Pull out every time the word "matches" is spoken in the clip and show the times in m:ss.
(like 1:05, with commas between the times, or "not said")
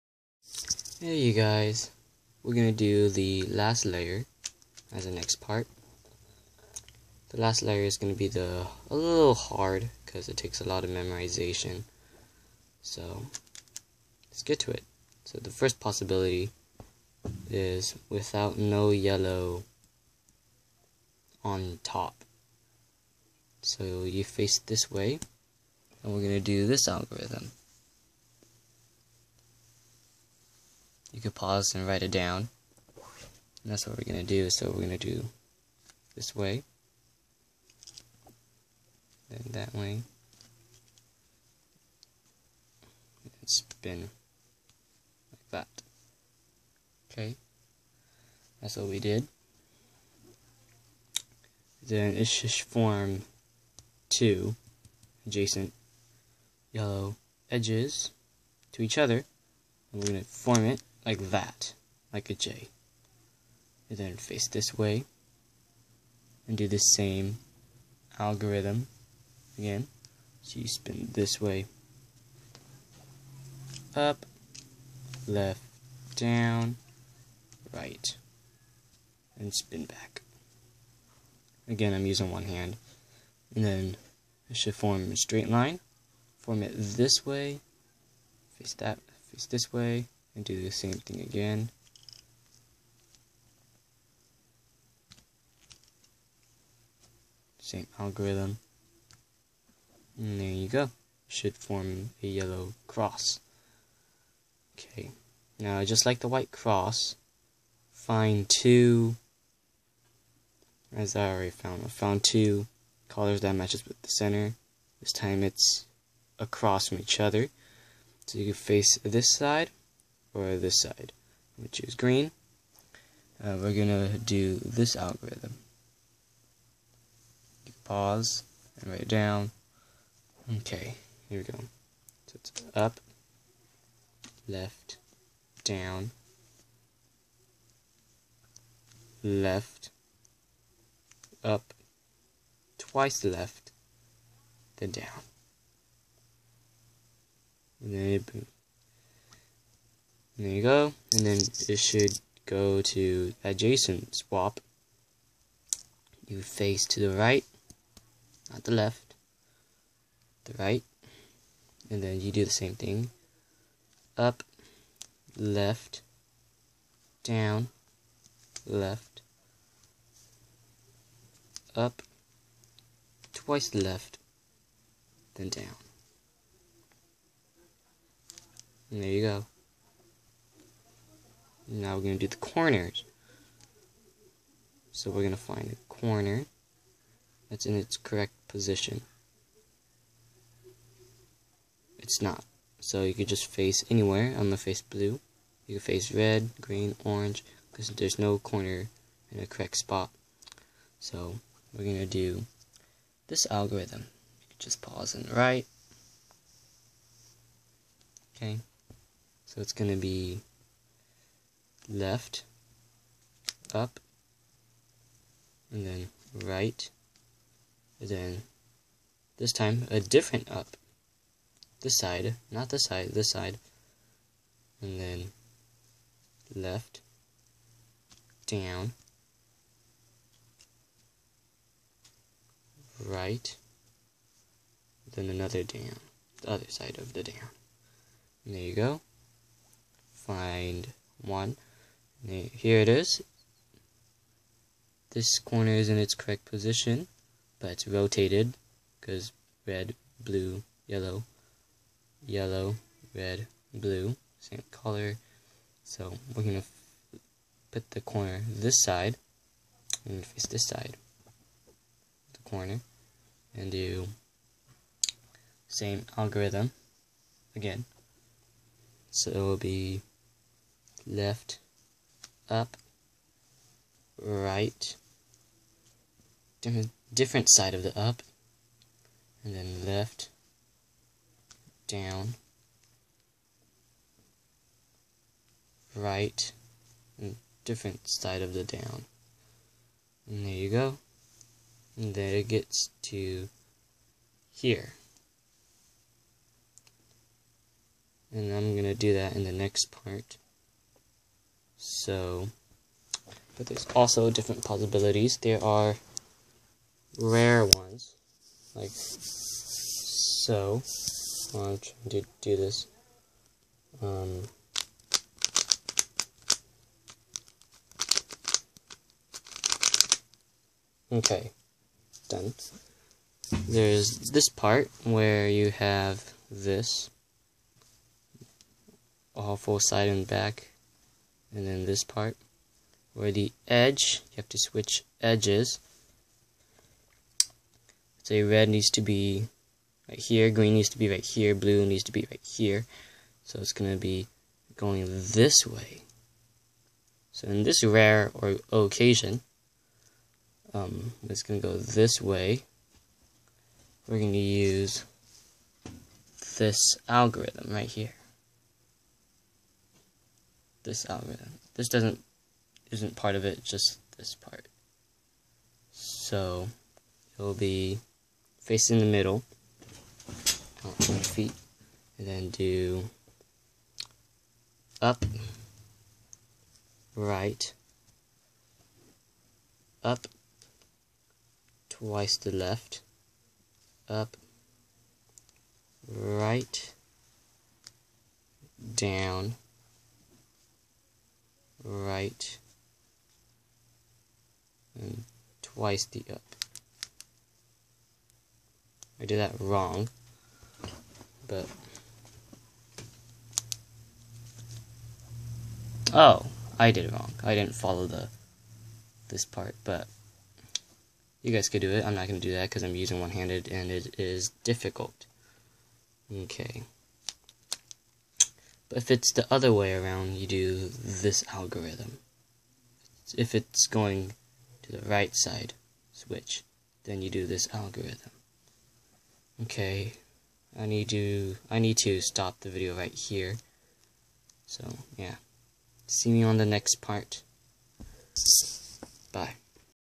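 1:53.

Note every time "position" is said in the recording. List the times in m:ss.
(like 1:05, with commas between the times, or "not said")
3:08, 4:06.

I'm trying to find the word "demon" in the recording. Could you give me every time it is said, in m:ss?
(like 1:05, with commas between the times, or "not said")
not said.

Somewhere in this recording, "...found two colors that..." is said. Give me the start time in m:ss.
1:51.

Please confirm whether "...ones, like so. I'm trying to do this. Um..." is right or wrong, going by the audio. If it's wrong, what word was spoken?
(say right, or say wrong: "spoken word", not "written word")
right.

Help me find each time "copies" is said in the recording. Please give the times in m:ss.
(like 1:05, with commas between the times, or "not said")
not said.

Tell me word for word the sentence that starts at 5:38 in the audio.
Say red needs to be right here, green needs to be right here, blue needs to be right here.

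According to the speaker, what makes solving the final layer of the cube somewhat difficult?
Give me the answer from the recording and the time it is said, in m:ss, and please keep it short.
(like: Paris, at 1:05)
A lot of memorization, at 0:10.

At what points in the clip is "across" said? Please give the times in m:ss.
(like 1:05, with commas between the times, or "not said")
1:56.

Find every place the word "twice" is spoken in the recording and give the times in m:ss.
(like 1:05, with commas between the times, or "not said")
2:22, 2:53, 6:21, 6:35.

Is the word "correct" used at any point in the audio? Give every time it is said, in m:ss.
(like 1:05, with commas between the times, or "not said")
3:07, 3:19, 4:06.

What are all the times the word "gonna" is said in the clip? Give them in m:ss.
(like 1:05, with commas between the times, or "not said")
0:02, 0:07, 0:26.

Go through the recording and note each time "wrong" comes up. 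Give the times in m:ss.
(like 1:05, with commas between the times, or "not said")
6:39, 6:47.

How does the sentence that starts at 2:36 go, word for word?
You face to the right, not the left, the right.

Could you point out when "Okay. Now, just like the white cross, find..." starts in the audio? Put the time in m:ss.
1:44.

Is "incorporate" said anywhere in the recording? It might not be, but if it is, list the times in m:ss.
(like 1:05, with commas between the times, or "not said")
not said.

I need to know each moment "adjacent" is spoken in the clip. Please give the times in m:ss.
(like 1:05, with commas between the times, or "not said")
0:55, 2:33.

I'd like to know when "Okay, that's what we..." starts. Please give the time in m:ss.
0:47.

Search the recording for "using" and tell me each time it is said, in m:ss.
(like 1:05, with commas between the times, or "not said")
1:22, 6:52.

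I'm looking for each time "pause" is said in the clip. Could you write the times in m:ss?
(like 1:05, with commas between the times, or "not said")
0:31, 2:07, 3:24.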